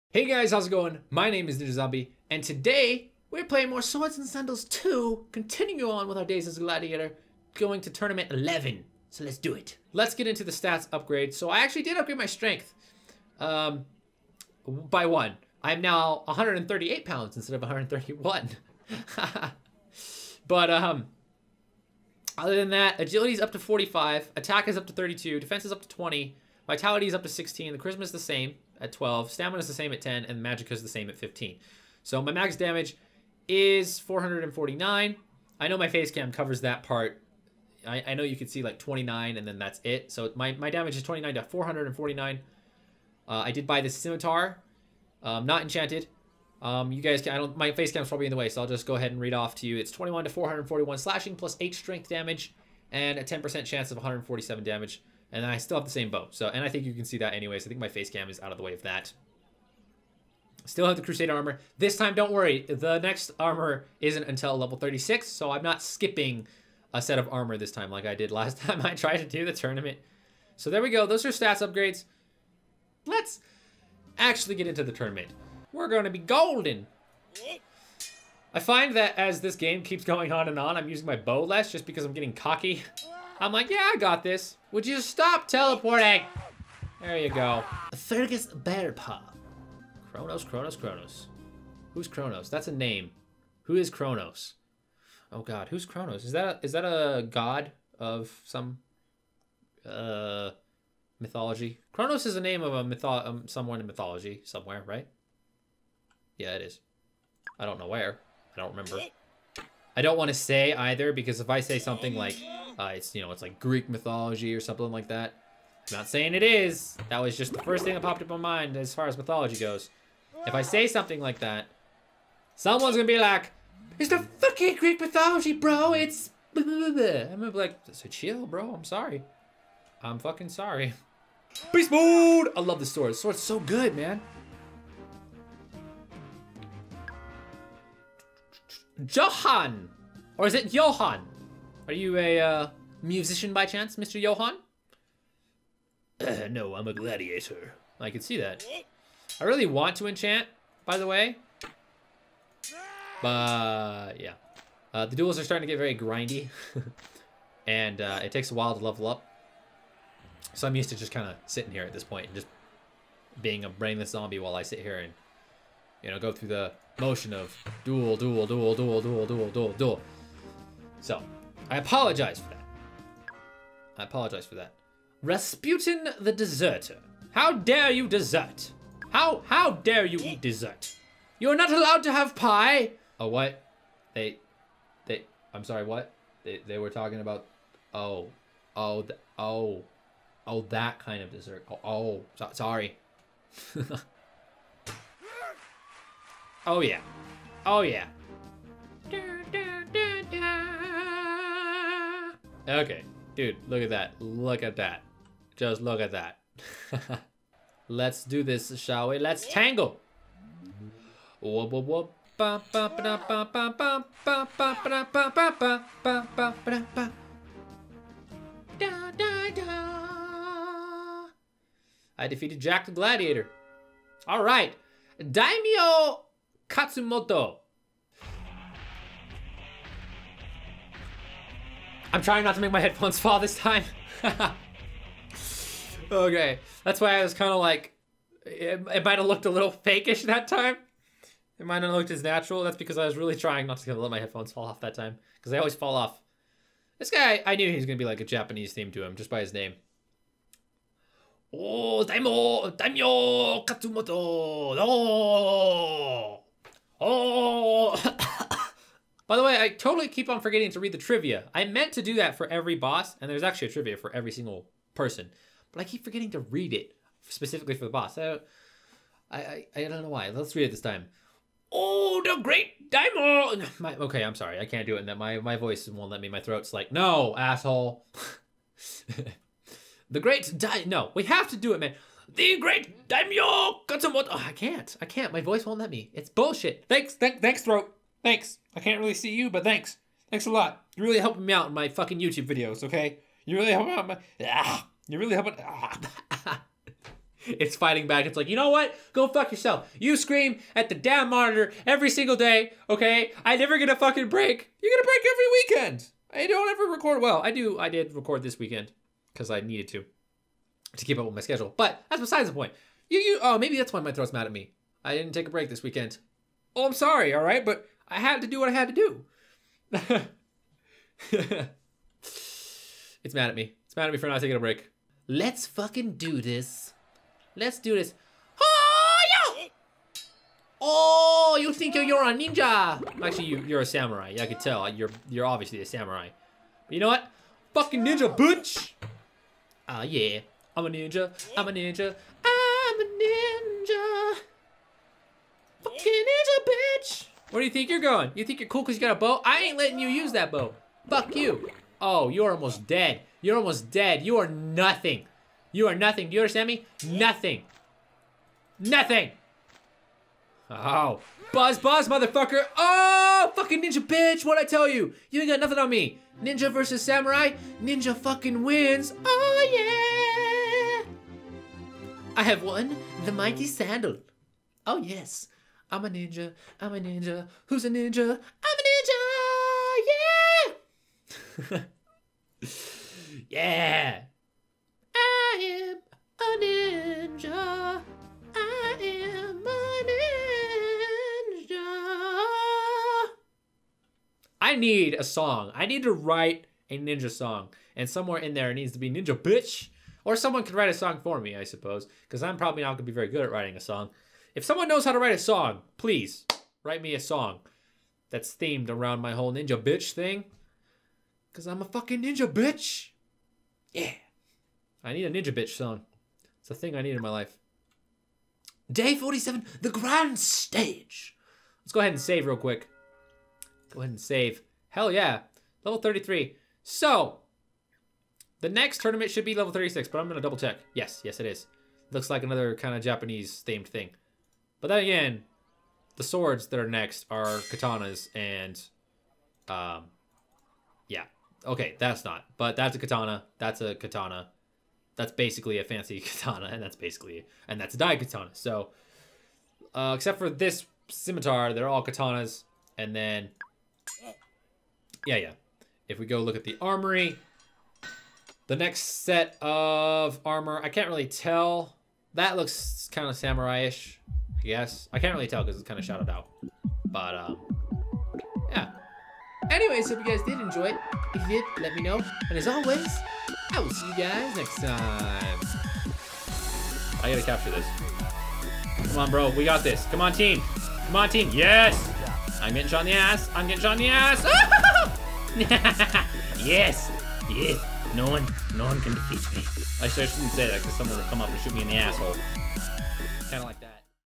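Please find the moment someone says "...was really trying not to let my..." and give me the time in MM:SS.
04:03.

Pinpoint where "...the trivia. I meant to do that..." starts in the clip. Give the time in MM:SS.
04:20.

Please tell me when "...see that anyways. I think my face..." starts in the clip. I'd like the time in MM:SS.
00:57.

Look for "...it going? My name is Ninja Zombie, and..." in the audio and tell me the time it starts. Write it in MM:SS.
00:00.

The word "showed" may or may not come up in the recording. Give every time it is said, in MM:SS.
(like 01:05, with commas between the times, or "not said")
not said.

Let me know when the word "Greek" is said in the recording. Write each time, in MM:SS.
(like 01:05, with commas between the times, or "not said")
01:53, 02:04.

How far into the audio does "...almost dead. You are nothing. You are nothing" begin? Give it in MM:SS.
05:53.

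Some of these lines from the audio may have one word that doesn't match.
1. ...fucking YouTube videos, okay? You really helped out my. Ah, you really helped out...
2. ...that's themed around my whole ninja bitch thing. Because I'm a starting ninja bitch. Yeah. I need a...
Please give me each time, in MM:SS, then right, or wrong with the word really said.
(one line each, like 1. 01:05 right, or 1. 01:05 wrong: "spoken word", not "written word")
1. 04:51 right
2. 06:48 wrong: "fucking", not "starting".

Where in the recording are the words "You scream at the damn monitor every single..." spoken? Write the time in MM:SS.
04:59.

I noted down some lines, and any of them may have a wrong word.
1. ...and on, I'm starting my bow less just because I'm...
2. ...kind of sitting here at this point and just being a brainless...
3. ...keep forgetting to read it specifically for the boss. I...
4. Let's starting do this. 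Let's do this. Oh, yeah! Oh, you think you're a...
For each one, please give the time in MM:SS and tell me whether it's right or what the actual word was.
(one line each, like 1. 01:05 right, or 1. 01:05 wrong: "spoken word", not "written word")
1. 01:20 wrong: "using", not "starting"
2. 02:41 right
3. 04:25 right
4. 05:25 wrong: "fucking", not "starting".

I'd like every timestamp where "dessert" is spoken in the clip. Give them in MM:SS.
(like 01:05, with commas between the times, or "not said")
03:00, 03:11.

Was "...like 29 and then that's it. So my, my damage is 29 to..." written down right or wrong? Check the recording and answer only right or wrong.
right.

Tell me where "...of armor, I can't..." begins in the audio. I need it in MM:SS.
07:39.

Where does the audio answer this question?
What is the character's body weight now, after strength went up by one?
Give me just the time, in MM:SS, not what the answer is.
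00:16.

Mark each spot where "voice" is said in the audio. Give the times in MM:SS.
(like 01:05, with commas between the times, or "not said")
04:35, 04:45.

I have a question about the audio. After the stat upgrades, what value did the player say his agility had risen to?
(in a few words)
45.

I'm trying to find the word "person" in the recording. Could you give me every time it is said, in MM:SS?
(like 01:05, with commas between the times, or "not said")
04:24.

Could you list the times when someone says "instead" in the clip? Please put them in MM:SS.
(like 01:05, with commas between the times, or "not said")
00:17.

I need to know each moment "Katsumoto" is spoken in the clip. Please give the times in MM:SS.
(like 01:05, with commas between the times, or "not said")
03:46, 04:13.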